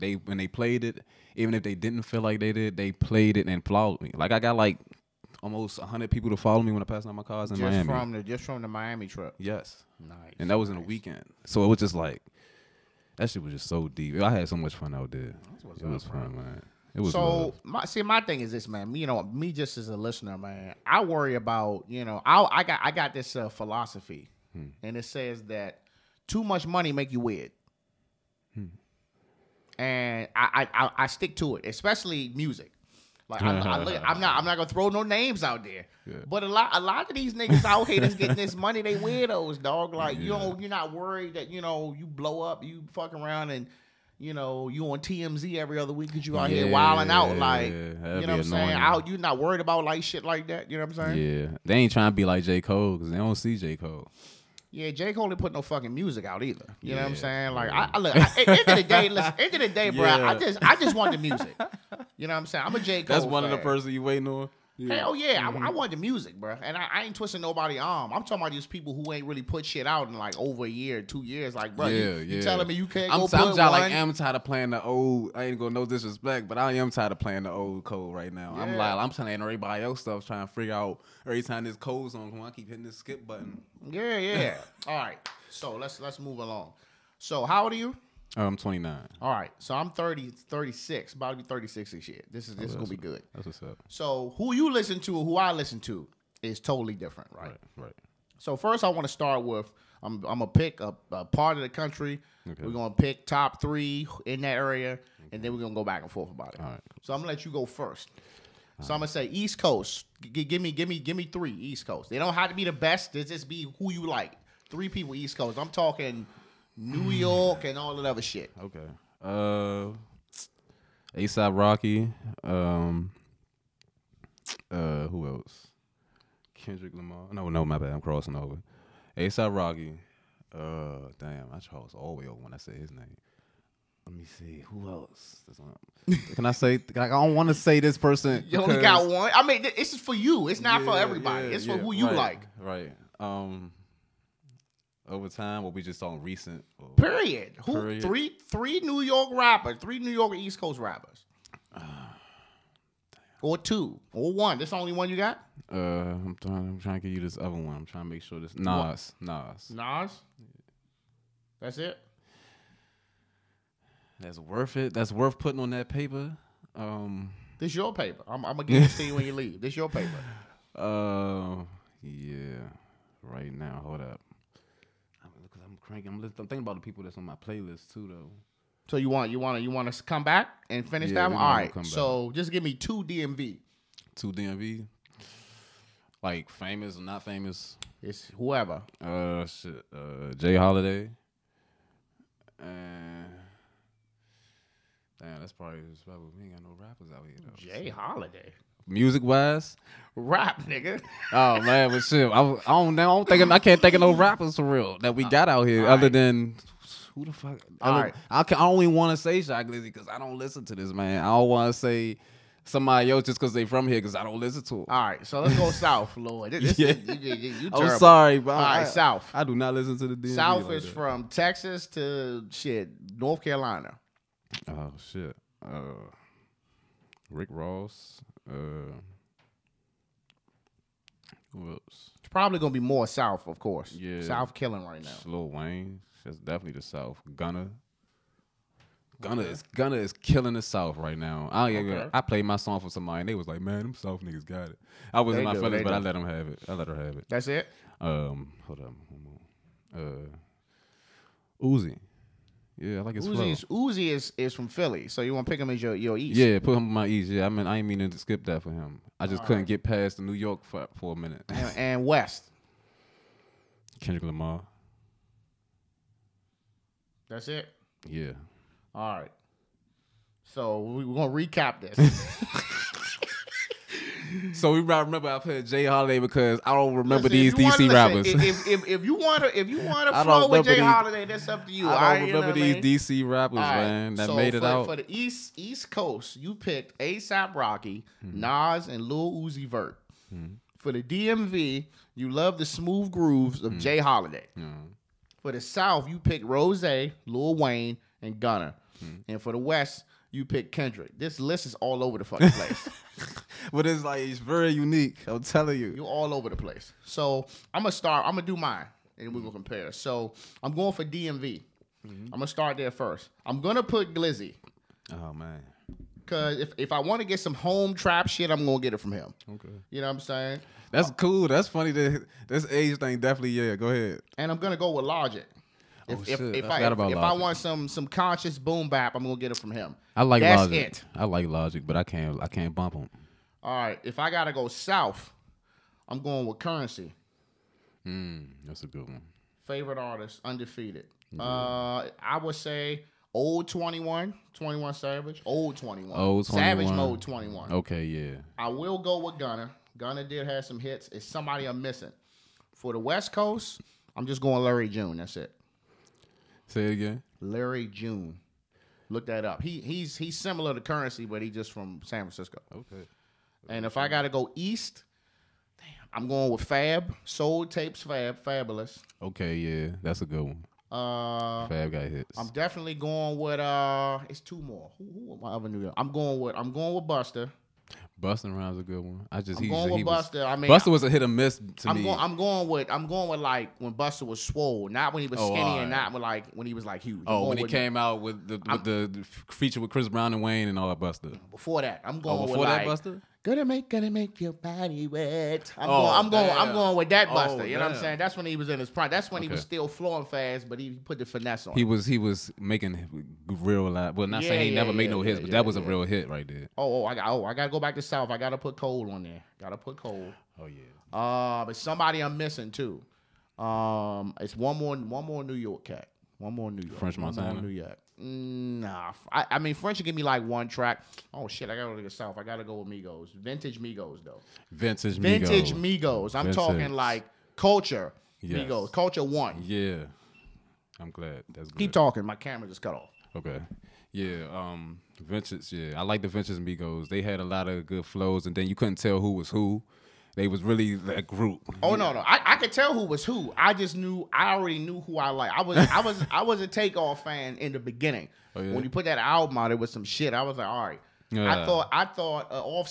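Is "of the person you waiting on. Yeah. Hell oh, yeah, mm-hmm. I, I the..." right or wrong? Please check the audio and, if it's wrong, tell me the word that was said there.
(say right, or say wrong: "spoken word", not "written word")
right.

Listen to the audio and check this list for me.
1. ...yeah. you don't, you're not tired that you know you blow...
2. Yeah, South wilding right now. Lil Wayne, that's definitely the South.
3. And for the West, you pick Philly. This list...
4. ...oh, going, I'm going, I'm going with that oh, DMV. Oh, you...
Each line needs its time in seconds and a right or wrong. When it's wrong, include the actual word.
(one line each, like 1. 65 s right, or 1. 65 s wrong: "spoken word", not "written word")
1. 40 s wrong: "worried", not "tired"
2. 233 s wrong: "killing", not "wilding"
3. 299 s wrong: "Kendrick", not "Philly"
4. 395 s wrong: "Busta", not "DMV".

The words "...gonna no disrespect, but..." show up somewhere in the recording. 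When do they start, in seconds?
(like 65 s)
75 s.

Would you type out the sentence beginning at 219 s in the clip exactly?
I do not listen to the DMV South like is that.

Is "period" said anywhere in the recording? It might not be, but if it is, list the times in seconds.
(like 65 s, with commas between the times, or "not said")
146 s.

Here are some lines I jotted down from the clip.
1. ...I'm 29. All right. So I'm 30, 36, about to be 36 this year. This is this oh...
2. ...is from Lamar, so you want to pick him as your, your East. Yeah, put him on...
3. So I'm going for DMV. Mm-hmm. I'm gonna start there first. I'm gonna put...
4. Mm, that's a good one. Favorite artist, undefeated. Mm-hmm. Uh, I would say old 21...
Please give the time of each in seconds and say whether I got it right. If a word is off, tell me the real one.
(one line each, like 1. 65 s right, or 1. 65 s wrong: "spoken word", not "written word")
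1. 88 s right
2. 254 s wrong: "Philly", not "Lamar"
3. 309 s right
4. 338 s right.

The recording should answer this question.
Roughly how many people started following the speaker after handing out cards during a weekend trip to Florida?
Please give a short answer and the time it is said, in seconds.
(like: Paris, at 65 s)
almost 100, at 5 s.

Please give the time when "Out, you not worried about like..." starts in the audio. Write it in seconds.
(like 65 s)
48 s.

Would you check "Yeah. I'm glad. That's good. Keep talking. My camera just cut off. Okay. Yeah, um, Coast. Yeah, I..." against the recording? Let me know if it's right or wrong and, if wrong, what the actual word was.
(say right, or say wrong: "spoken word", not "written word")
wrong: "Vintage", not "Coast".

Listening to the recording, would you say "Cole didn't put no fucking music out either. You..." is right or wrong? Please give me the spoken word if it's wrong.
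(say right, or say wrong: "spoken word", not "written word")
right.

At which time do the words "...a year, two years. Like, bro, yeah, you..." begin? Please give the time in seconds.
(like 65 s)
70 s.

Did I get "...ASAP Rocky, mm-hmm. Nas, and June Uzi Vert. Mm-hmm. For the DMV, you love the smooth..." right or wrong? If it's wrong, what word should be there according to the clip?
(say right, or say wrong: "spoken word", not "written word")
wrong: "Lil", not "June".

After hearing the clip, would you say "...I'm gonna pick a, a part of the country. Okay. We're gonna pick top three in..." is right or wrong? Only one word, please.
right.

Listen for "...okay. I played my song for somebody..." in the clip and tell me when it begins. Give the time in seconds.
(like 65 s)
241 s.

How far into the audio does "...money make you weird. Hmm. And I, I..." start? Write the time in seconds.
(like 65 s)
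26 s.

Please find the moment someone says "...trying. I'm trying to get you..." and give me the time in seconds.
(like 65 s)
156 s.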